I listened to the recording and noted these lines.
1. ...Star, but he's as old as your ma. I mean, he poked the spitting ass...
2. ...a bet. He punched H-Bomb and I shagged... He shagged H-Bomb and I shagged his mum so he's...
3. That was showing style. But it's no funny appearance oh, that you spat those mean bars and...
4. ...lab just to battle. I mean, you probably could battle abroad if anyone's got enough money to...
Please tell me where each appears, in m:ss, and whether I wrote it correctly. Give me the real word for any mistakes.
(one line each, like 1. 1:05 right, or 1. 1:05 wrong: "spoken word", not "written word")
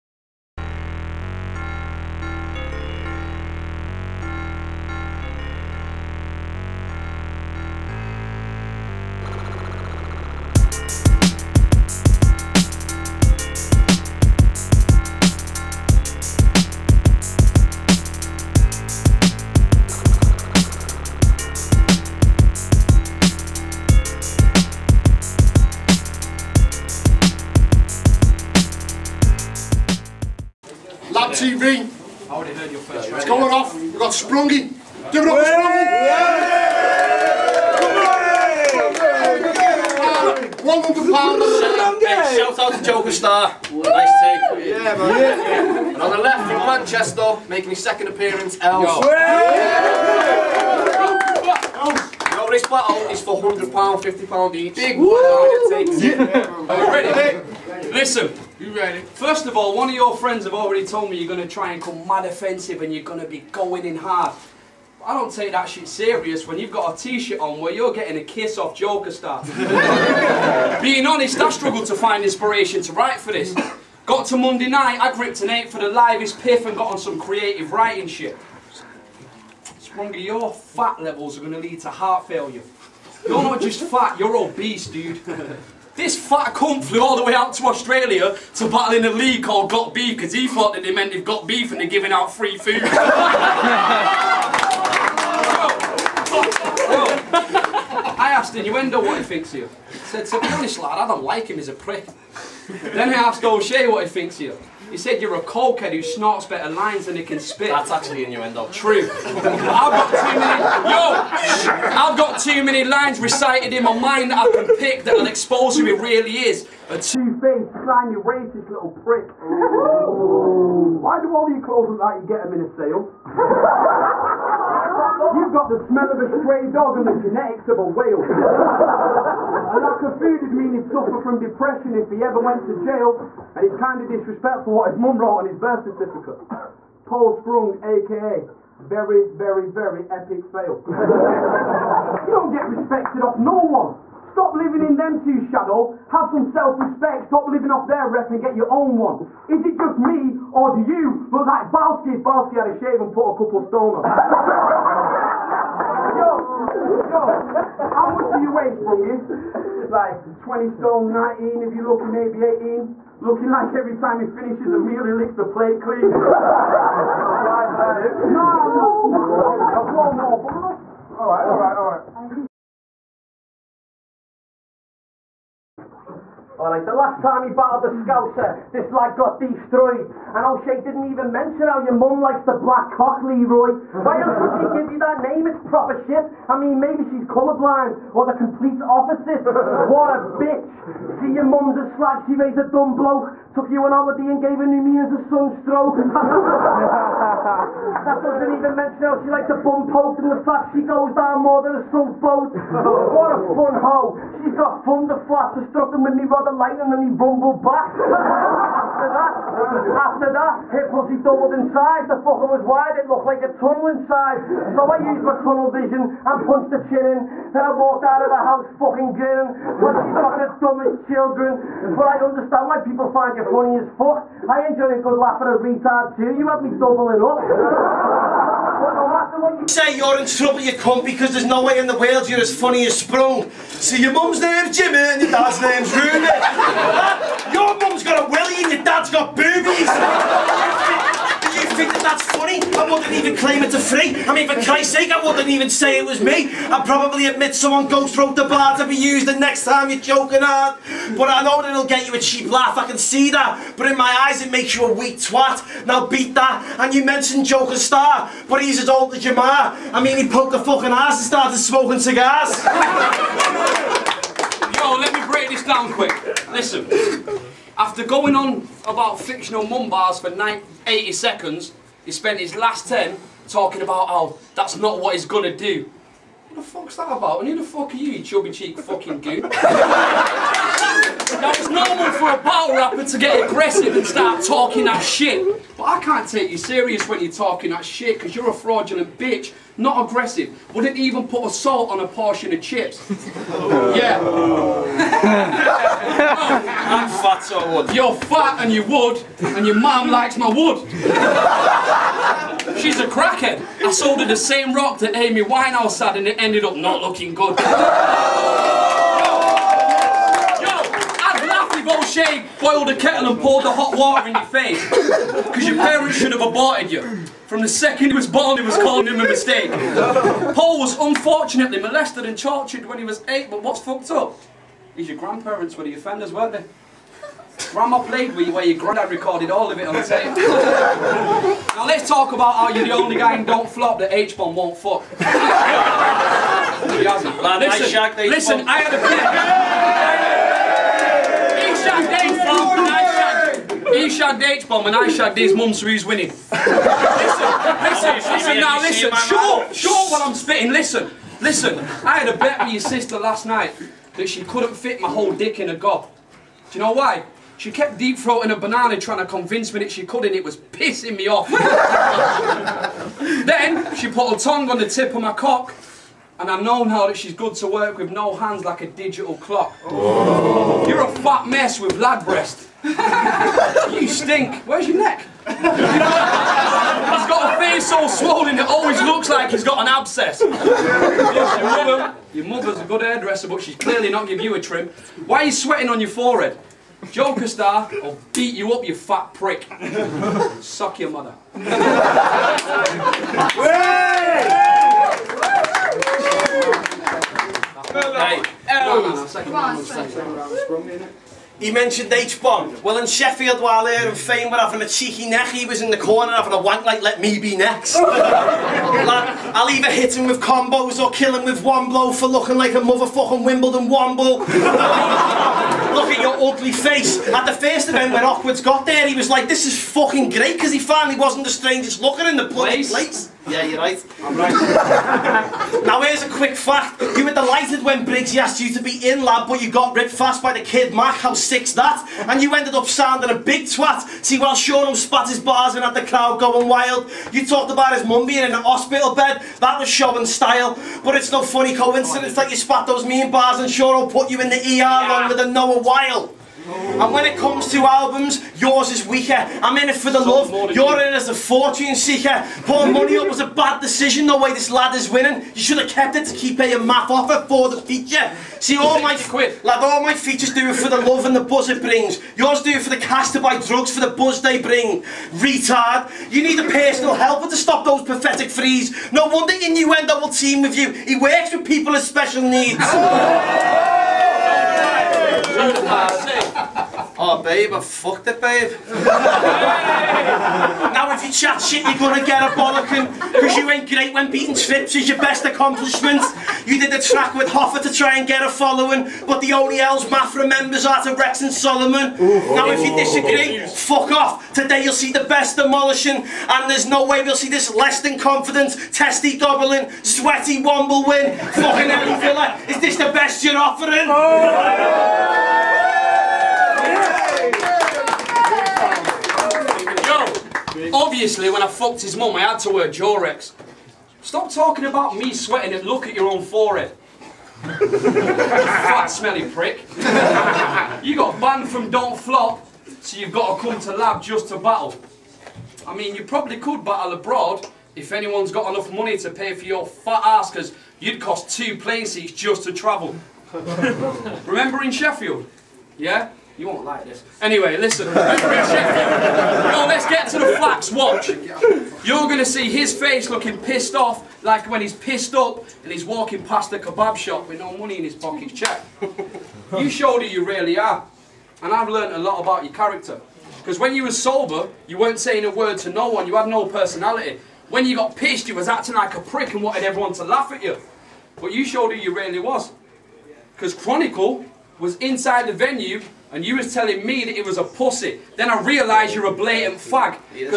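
1. 4:17 wrong: "fucking", not "spitting"
2. 5:41 wrong: "shagged", not "punched"
3. 7:19 wrong: "coincidence", not "appearance"
4. 8:43 right.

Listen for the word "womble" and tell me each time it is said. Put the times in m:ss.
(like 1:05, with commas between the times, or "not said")
6:53, 8:20.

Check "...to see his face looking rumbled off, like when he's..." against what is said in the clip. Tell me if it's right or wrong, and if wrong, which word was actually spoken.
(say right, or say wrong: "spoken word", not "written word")
wrong: "pissed", not "rumbled".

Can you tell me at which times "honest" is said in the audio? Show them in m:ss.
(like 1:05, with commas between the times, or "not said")
1:11, 1:40.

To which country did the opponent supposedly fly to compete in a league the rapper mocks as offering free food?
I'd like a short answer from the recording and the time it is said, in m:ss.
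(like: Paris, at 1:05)
Australia, at 1:27.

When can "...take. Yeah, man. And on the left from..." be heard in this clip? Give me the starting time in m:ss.
0:43.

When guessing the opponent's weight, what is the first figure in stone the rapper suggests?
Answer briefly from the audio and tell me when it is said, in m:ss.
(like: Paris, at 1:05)
20 stone, at 2:40.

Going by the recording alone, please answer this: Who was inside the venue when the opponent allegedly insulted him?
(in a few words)
Chronicle.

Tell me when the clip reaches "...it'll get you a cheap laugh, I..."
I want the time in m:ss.
4:11.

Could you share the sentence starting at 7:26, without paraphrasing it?
And when it comes to albums, yours is weaker.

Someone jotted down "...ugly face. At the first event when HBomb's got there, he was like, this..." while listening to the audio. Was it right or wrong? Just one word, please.
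wrong.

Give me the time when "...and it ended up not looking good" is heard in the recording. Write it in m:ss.
5:06.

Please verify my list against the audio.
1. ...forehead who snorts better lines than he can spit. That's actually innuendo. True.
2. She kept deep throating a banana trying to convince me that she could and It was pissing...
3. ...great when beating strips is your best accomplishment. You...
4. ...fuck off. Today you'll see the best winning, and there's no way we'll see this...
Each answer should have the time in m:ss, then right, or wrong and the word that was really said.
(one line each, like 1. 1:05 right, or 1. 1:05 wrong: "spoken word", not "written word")
1. 1:45 wrong: "cokehead", not "forehead"
2. 5:57 right
3. 8:03 right
4. 8:13 wrong: "demolishing", not "winning".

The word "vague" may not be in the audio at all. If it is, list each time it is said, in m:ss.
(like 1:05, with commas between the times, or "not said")
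not said.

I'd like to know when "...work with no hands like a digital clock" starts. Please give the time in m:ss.
6:07.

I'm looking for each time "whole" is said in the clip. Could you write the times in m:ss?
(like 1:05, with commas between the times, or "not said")
5:55.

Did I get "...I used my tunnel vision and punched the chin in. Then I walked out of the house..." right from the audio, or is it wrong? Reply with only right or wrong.
right.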